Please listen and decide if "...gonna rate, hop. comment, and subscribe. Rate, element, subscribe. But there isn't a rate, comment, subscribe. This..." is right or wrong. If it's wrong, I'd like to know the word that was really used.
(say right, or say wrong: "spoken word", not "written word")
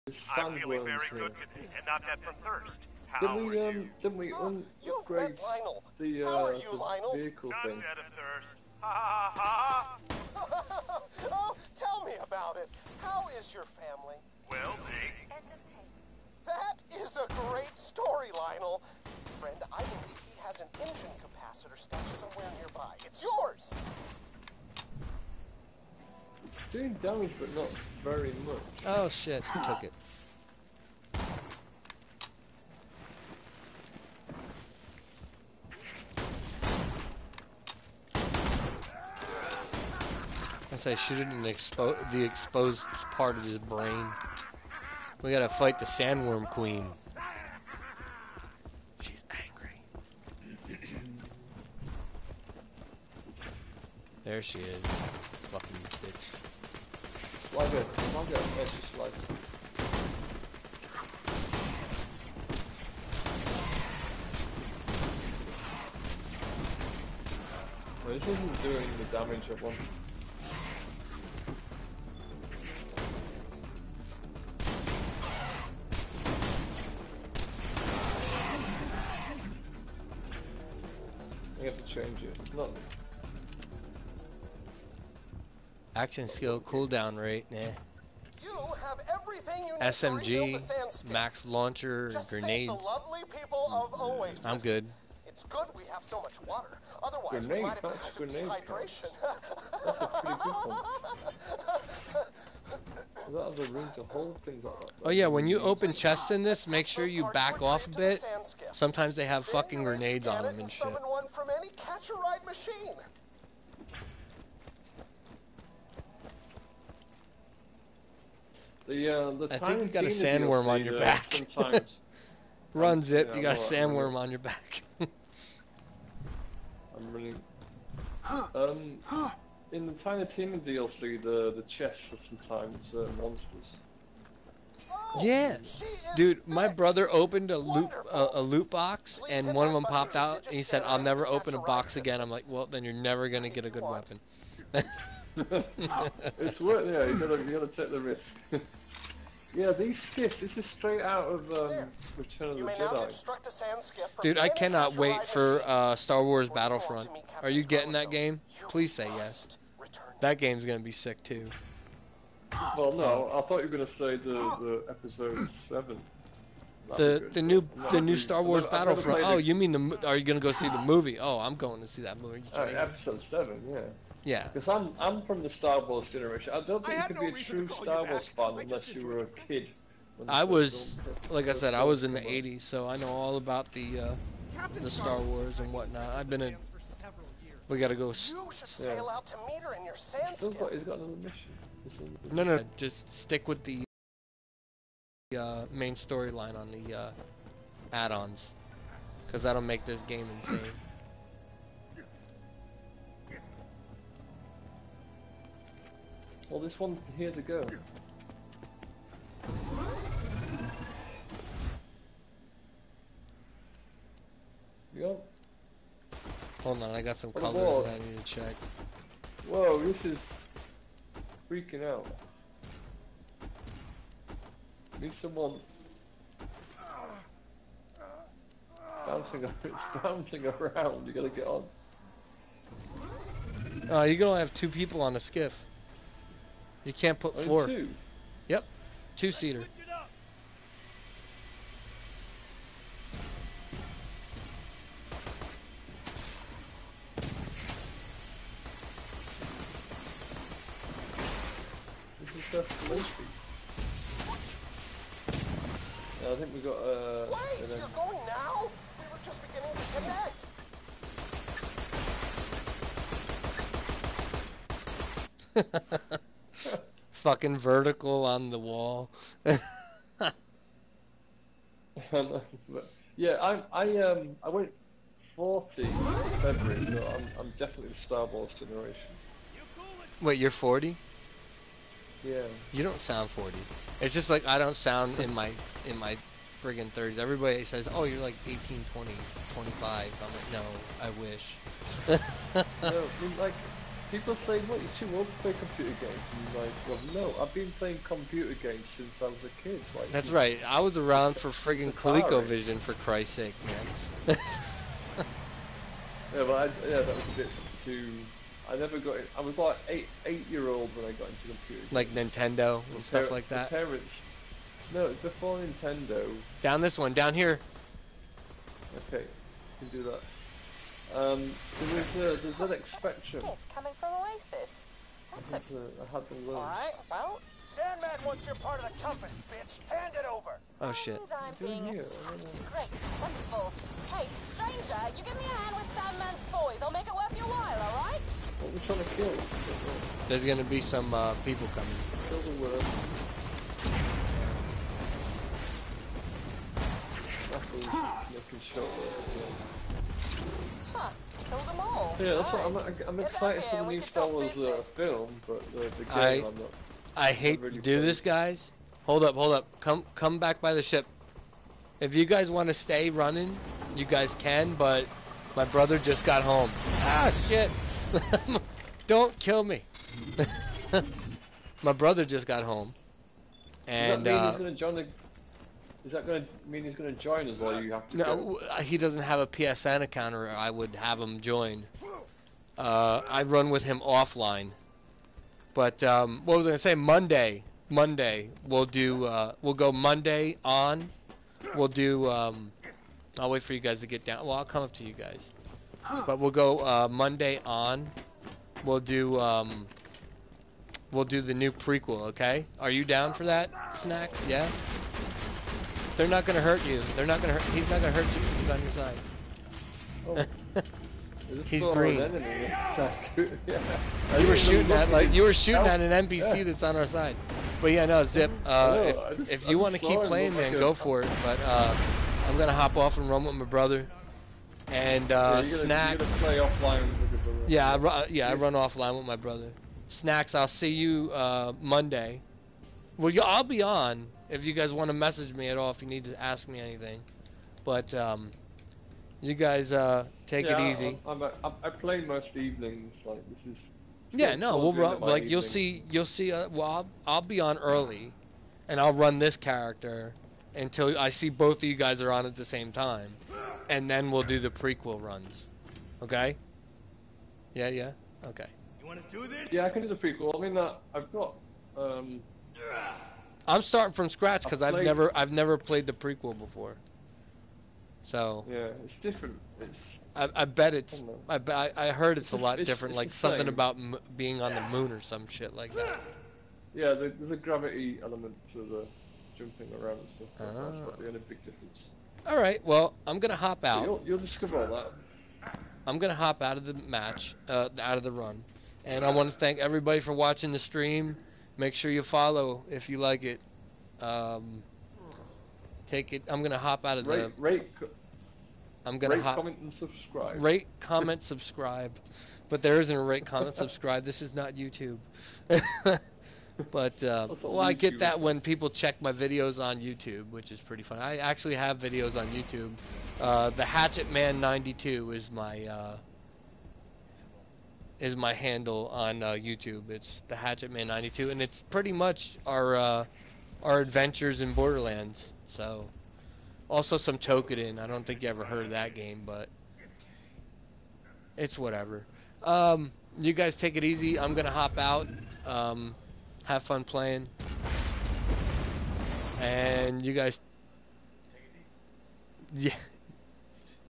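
wrong: "comment", not "element".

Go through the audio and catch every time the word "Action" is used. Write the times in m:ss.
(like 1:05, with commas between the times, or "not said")
1:25.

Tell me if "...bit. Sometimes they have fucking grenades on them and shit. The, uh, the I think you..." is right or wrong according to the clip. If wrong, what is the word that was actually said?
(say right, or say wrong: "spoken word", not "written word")
right.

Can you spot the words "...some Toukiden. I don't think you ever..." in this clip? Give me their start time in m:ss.
8:47.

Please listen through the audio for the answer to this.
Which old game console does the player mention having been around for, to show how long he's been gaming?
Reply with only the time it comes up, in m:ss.
5:01.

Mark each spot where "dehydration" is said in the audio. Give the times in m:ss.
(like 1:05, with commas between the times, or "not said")
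1:37.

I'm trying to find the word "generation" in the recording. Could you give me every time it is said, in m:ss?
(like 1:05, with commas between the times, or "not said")
2:56, 4:38.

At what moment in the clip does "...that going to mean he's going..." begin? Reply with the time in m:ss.
6:16.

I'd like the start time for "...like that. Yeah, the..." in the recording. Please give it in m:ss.
7:55.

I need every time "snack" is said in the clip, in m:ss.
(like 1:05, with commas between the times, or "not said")
6:44, 7:05, 7:10.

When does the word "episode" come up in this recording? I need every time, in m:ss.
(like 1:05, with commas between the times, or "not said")
2:44, 2:52.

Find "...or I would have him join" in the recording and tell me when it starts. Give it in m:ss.
6:20.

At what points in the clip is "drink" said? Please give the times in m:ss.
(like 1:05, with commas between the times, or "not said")
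not said.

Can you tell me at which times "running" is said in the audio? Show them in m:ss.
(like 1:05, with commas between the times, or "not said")
6:03.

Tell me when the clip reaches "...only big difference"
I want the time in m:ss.
8:01.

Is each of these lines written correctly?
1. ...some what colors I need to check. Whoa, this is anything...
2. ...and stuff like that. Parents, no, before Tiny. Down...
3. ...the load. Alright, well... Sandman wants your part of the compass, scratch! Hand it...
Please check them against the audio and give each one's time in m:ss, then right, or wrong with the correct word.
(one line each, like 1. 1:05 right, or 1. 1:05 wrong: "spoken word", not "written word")
1. 3:37 wrong: "freaking", not "anything"
2. 5:12 wrong: "Nintendo", not "Tiny"
3. 5:26 wrong: "bitch", not "scratch".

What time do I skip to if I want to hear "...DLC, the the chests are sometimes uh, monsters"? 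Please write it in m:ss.
2:10.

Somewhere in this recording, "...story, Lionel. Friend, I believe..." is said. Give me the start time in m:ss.
0:17.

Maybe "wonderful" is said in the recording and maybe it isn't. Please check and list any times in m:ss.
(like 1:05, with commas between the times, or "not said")
5:33.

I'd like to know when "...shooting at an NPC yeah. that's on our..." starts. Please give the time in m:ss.
6:55.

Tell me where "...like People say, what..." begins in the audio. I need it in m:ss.
4:53.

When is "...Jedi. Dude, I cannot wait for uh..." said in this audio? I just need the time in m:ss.
2:32.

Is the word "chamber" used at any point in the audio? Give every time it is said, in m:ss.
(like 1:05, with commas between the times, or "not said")
not said.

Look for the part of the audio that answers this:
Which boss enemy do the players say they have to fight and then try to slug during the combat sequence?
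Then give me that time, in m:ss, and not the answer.
0:45.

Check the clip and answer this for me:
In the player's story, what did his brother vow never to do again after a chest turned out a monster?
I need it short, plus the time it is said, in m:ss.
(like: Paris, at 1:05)
Open a box, at 2:21.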